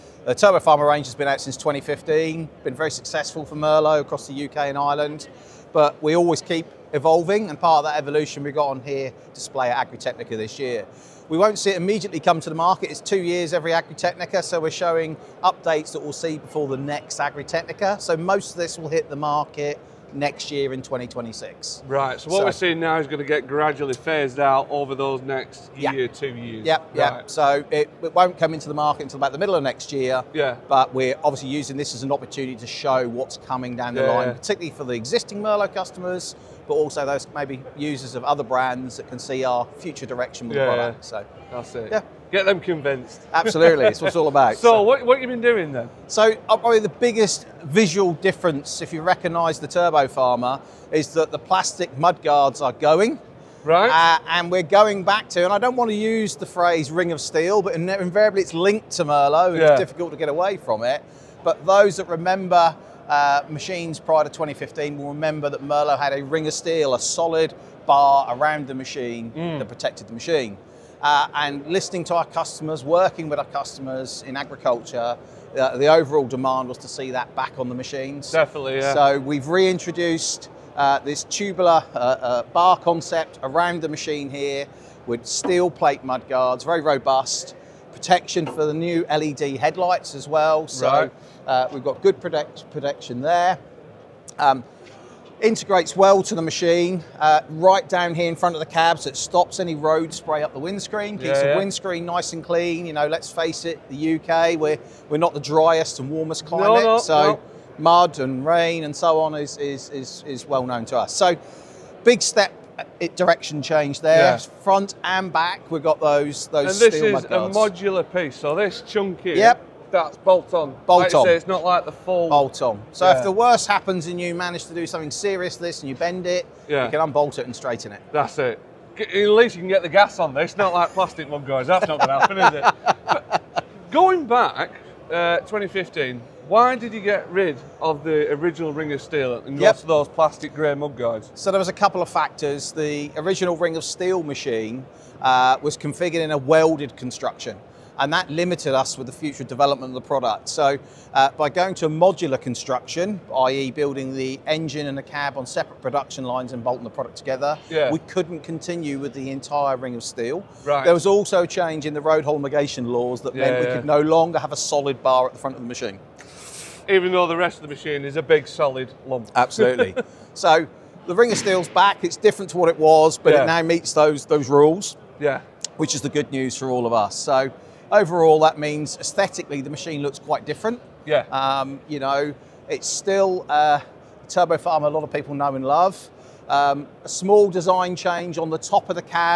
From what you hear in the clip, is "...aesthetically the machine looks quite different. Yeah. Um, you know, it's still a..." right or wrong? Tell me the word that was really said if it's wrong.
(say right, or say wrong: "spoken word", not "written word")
right.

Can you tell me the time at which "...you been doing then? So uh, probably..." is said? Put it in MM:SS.
00:45.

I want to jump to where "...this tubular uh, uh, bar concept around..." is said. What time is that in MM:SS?
01:20.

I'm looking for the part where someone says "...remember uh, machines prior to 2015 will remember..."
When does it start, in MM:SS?
01:02.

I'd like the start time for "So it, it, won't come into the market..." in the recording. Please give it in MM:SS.
00:27.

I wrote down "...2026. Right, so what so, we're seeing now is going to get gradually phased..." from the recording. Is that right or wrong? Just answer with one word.
right.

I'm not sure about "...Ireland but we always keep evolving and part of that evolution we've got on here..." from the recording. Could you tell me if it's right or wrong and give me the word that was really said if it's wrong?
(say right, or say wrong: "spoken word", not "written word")
right.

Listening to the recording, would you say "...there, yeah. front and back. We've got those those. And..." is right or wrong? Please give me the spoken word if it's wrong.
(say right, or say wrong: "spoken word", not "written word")
right.